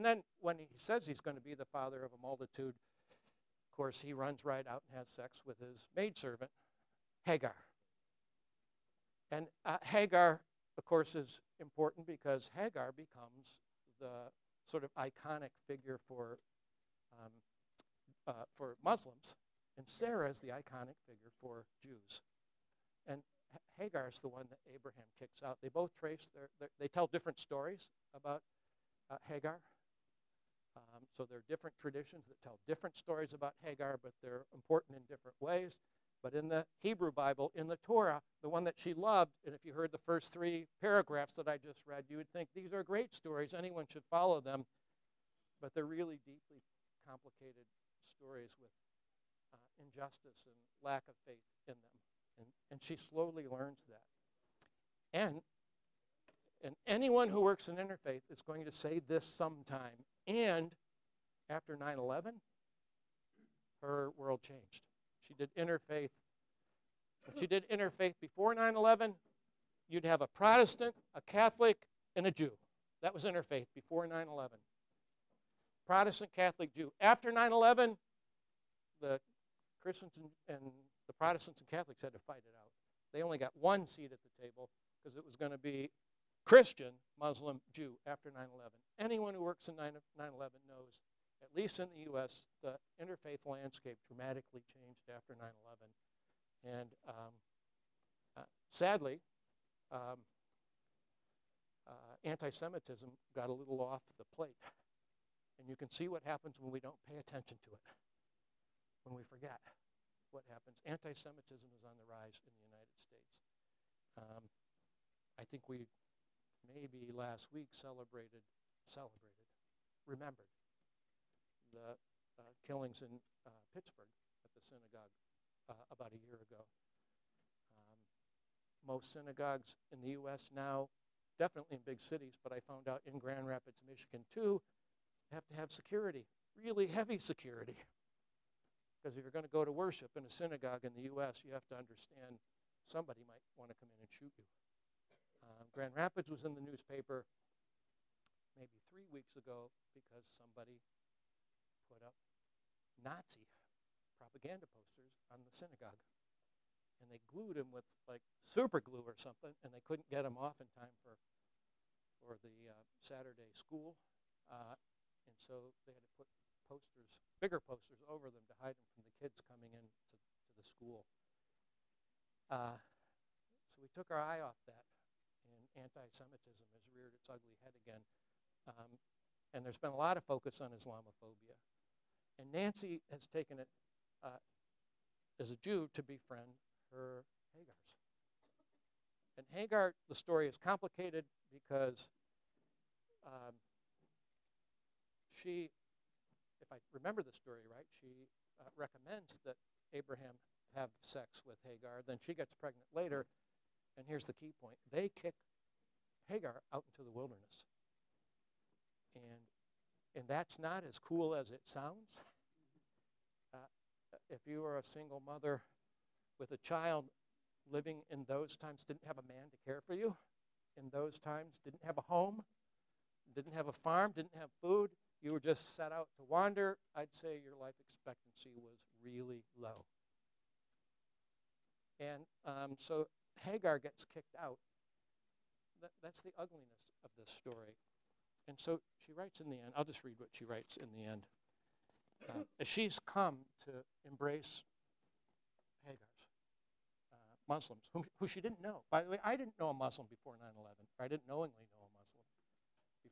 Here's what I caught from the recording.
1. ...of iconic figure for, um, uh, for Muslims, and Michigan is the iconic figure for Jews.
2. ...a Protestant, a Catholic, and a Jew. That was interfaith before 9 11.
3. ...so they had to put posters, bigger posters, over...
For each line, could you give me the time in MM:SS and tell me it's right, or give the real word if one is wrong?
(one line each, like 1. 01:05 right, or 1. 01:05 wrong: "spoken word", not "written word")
1. 00:14 wrong: "Sarah", not "Michigan"
2. 01:10 right
3. 02:45 right.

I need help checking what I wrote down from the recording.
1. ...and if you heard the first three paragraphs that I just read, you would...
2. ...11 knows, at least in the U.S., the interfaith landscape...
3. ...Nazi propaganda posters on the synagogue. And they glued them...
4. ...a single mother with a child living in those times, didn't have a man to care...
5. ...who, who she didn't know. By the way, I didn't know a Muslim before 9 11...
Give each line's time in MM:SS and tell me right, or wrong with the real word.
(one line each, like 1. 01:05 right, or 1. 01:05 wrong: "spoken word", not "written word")
1. 00:39 right
2. 01:30 right
3. 02:33 right
4. 03:34 right
5. 04:07 right.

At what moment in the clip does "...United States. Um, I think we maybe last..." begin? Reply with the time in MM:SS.
01:52.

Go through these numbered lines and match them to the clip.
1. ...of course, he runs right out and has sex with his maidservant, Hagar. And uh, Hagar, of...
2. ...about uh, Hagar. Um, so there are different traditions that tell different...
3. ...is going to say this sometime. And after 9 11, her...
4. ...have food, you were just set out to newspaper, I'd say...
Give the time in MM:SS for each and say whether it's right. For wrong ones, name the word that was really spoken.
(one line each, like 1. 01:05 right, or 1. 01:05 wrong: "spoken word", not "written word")
1. 00:03 right
2. 00:28 right
3. 00:58 right
4. 03:44 wrong: "wander", not "newspaper".